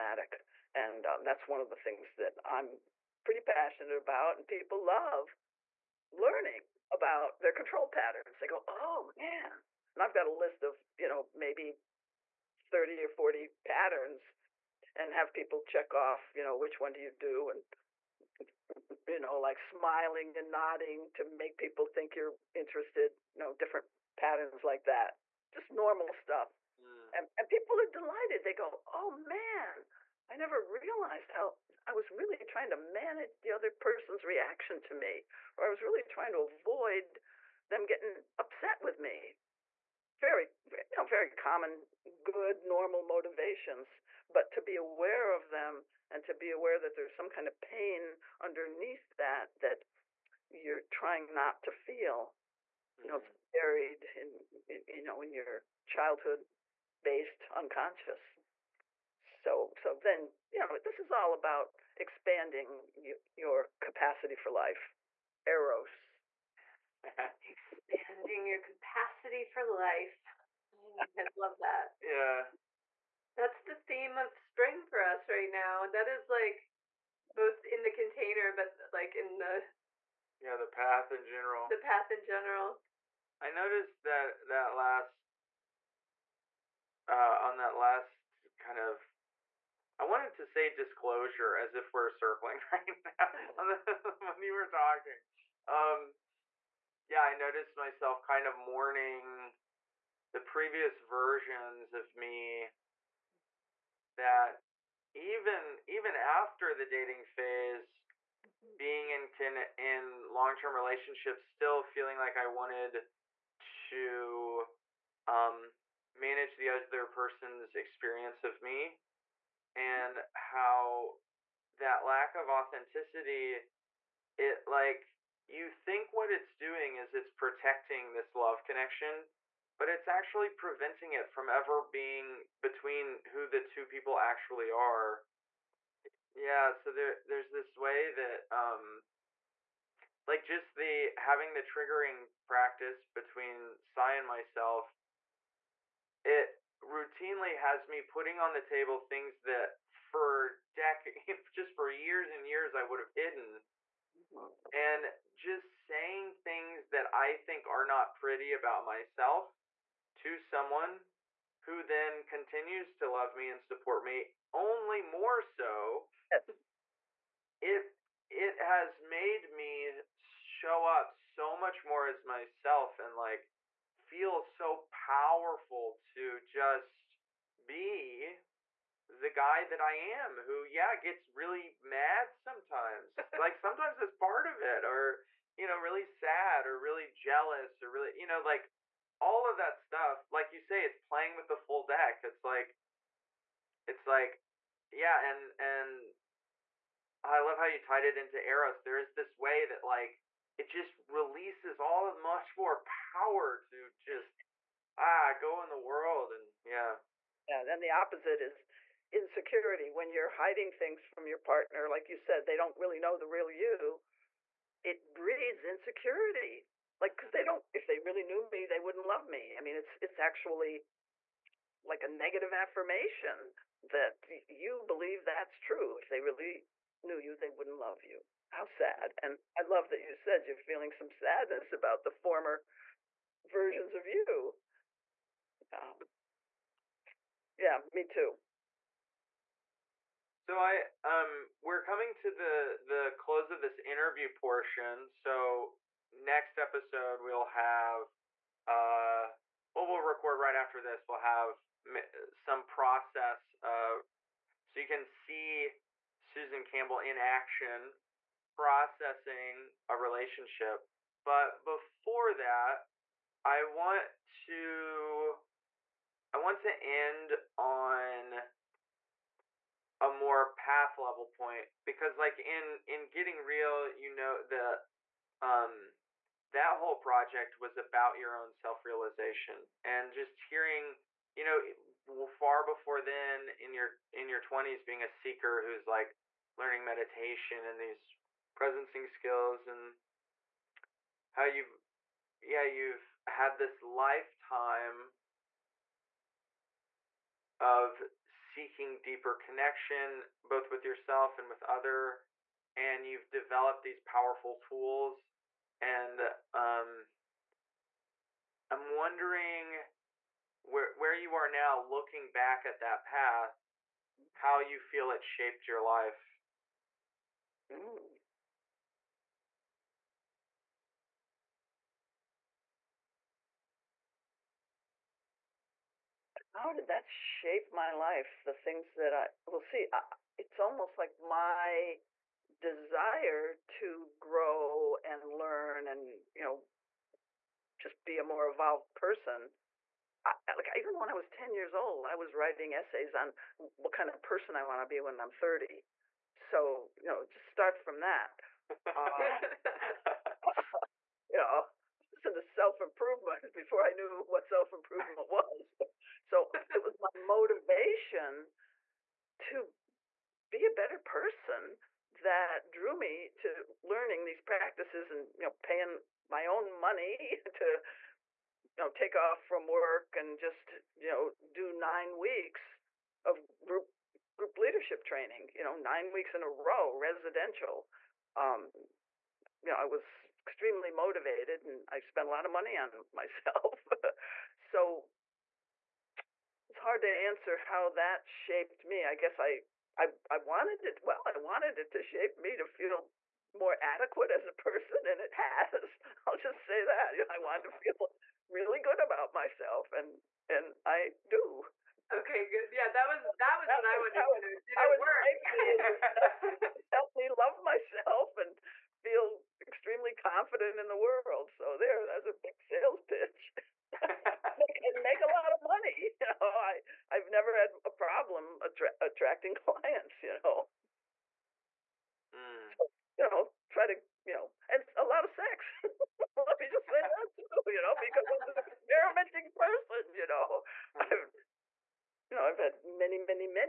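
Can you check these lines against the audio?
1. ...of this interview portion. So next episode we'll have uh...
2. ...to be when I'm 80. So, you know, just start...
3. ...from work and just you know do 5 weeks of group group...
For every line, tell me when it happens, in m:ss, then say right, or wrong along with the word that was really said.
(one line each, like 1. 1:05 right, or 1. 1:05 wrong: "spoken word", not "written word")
1. 4:03 right
2. 5:44 wrong: "30", not "80"
3. 6:09 wrong: "9", not "5".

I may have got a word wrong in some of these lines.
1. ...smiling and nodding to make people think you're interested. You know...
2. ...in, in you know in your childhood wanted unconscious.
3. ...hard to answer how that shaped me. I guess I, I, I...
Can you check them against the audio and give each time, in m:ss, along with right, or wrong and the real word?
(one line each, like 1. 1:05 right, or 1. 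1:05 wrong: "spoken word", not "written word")
1. 0:19 right
2. 0:54 wrong: "based", not "wanted"
3. 6:26 right.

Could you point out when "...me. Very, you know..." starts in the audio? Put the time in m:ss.
0:38.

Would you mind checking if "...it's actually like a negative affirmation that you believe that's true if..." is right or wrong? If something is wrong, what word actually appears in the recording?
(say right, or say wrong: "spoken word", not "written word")
right.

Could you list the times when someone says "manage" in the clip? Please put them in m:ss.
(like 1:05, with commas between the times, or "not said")
0:32, 1:56.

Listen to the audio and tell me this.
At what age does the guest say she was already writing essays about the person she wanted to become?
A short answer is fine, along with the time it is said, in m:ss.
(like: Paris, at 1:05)
10, at 5:41.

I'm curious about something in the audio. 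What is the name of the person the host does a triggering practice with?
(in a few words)
Sigh.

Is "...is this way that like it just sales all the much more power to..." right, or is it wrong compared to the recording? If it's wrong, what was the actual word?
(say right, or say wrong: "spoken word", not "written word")
wrong: "releases", not "sales".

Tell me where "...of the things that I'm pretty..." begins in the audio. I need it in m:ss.
0:01.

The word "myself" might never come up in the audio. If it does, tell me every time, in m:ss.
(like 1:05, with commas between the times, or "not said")
1:37, 2:24, 2:38, 2:52, 6:23, 6:39, 6:47.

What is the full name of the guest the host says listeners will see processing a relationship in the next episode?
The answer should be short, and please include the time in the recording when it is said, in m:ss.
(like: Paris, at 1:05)
Susan Campbell, at 4:16.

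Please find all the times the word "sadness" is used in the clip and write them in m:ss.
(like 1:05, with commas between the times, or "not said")
3:51.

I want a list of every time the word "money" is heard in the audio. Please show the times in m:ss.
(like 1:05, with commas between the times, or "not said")
6:06, 6:22, 6:55.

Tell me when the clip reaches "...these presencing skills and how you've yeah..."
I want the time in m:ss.
4:47.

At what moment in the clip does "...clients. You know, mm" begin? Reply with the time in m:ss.
6:59.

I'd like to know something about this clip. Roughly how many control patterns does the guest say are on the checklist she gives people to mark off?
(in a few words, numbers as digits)
30 or 40.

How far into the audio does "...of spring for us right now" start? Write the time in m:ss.
1:14.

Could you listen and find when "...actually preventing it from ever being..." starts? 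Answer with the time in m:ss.
2:10.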